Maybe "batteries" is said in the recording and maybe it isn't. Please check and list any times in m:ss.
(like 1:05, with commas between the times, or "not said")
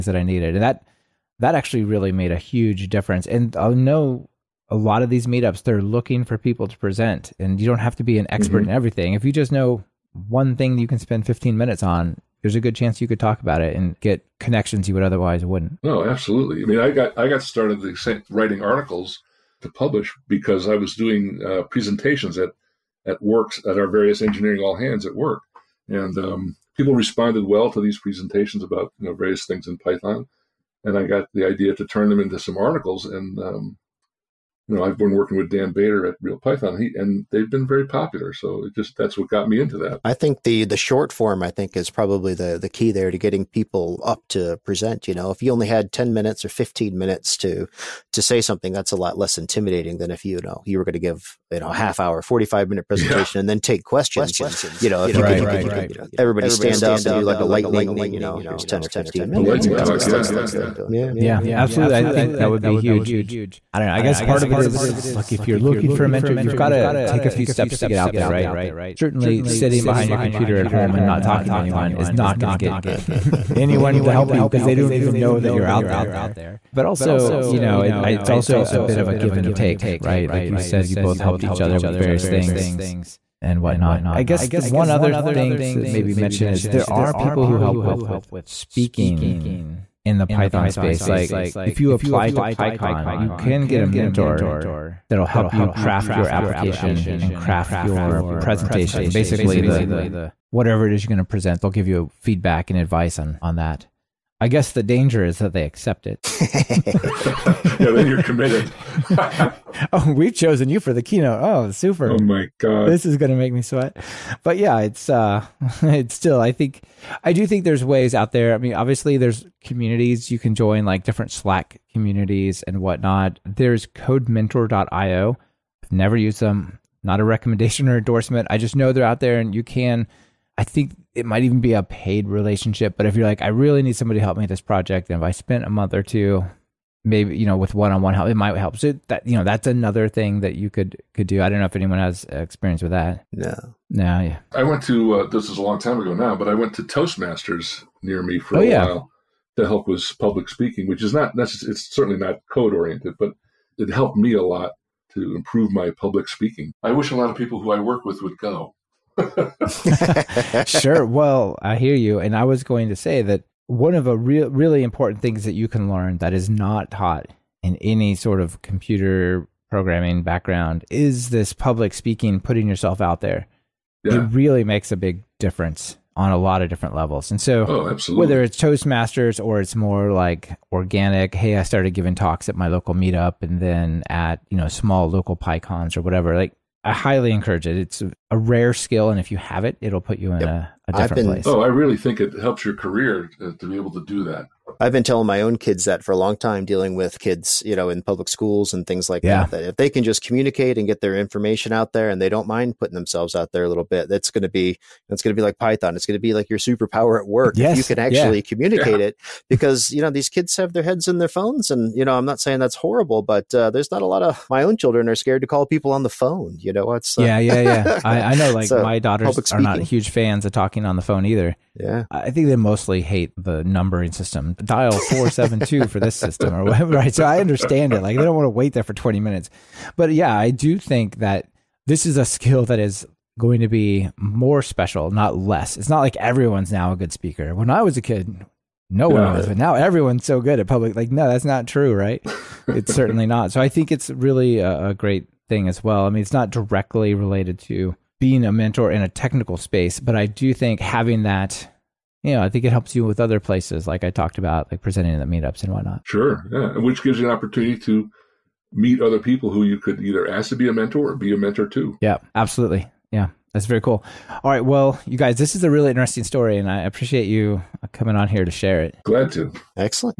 not said.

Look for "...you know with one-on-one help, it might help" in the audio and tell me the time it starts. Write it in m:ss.
2:17.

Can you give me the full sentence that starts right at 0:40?
I think the the short form, I think, is probably the the key there to getting people up to present.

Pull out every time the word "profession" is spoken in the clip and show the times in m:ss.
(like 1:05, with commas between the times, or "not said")
not said.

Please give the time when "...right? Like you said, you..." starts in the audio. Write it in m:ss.
1:19.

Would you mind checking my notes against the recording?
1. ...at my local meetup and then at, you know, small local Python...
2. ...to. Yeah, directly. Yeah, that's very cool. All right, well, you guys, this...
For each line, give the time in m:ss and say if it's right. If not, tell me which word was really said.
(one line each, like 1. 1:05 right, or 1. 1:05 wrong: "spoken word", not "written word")
1. 3:02 wrong: "PyCons", not "Python"
2. 4:21 wrong: "absolutely", not "directly".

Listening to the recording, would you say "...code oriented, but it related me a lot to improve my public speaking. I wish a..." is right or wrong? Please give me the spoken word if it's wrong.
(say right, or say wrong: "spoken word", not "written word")
wrong: "helped", not "related".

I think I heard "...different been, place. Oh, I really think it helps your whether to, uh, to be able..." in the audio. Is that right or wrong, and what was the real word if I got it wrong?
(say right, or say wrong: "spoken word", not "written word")
wrong: "career", not "whether".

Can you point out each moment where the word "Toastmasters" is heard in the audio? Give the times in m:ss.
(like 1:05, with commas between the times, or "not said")
2:26, 2:58.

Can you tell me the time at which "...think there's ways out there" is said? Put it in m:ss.
1:57.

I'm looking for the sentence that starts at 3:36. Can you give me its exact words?
You know, what's uh, yeah, yeah, yeah.